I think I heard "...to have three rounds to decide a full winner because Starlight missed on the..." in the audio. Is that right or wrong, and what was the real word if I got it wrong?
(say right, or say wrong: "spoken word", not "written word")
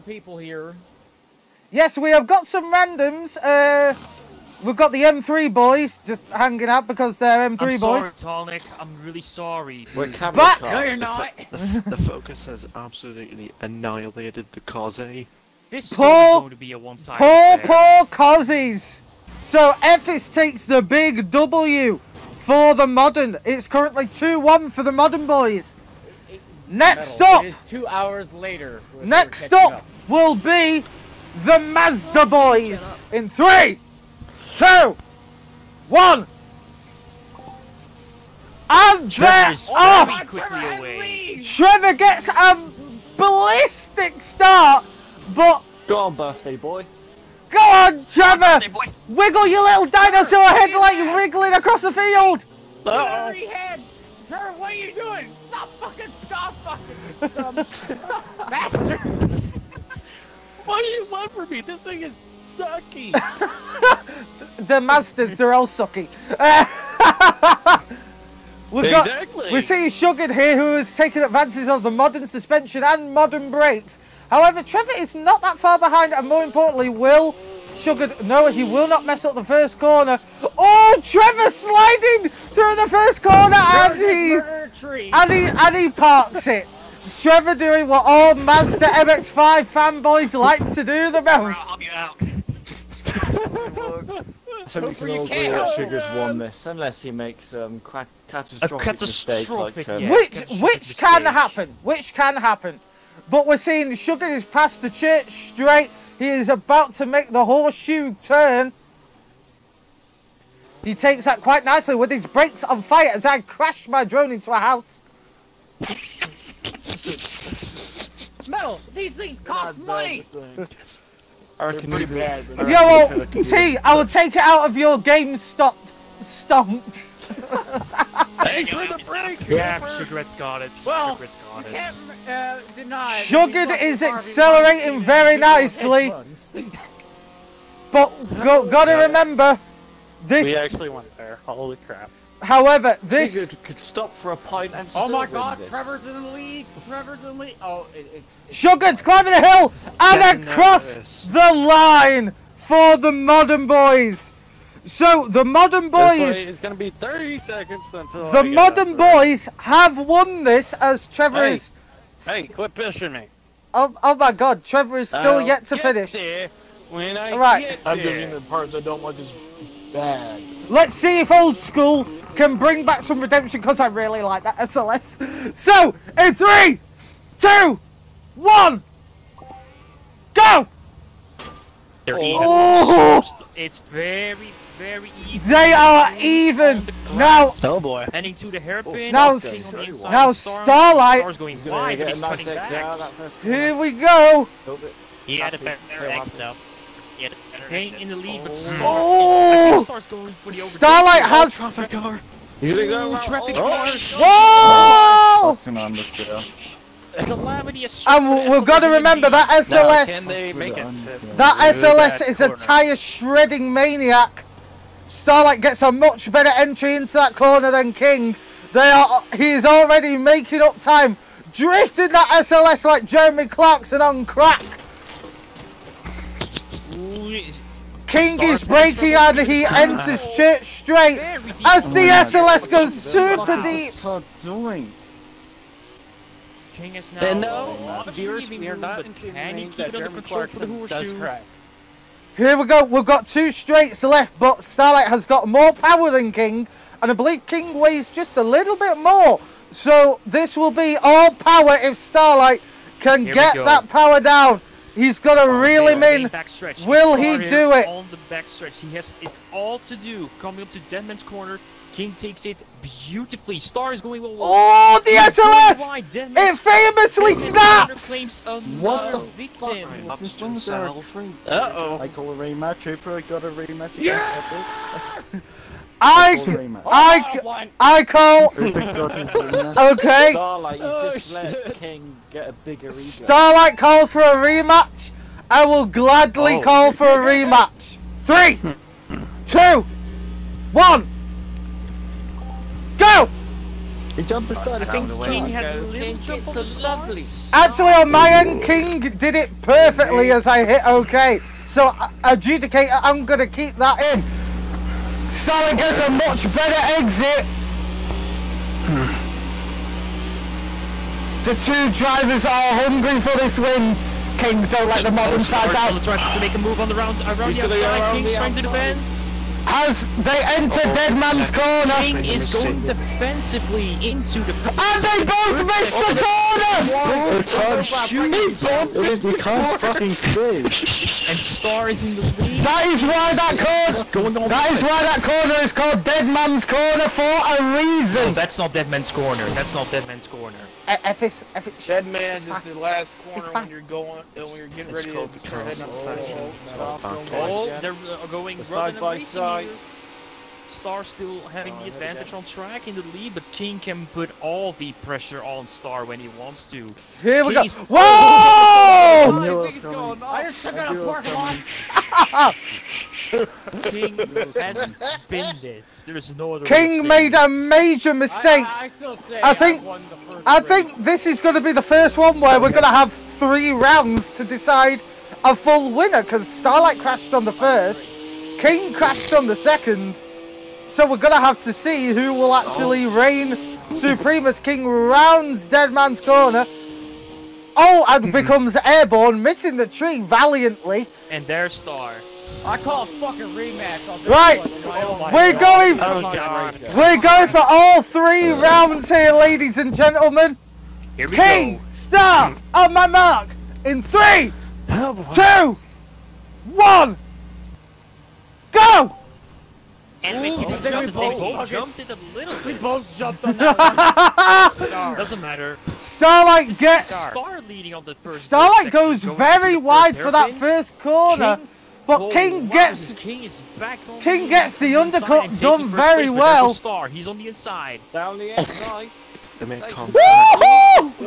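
wrong: "crashed", not "missed".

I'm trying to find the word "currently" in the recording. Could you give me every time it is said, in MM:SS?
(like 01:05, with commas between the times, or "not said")
00:23.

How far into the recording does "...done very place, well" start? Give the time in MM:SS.
07:05.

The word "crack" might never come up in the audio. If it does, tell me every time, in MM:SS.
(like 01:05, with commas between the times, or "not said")
03:44, 04:01.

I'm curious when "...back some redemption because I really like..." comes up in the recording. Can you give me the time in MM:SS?
02:52.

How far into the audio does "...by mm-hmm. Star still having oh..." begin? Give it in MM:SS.
05:49.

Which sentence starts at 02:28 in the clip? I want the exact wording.
Sugared's climbing a hill and across the line for the modern boys!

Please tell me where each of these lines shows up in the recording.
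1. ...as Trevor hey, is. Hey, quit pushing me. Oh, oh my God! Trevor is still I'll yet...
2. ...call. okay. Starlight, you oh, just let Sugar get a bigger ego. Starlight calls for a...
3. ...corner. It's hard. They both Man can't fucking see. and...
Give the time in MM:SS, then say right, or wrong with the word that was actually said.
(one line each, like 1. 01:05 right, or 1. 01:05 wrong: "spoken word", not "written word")
1. 02:40 right
2. 04:38 wrong: "King", not "Sugar"
3. 05:27 wrong: "You", not "Man".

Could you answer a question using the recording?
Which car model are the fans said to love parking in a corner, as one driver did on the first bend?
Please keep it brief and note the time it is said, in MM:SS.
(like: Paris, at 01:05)
Mazda MX-5, at 01:28.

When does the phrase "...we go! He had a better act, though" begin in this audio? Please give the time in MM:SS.
03:13.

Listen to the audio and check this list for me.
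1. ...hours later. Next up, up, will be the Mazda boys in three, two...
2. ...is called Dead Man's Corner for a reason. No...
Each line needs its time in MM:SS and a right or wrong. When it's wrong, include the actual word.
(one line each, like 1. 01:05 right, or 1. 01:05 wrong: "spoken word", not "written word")
1. 00:27 right
2. 05:35 right.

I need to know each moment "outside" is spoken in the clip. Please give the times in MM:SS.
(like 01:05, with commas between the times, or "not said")
05:17, 05:45.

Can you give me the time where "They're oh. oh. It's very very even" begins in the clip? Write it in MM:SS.
03:02.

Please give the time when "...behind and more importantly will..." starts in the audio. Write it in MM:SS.
01:15.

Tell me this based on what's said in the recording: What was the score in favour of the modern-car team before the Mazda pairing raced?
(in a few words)
2-1.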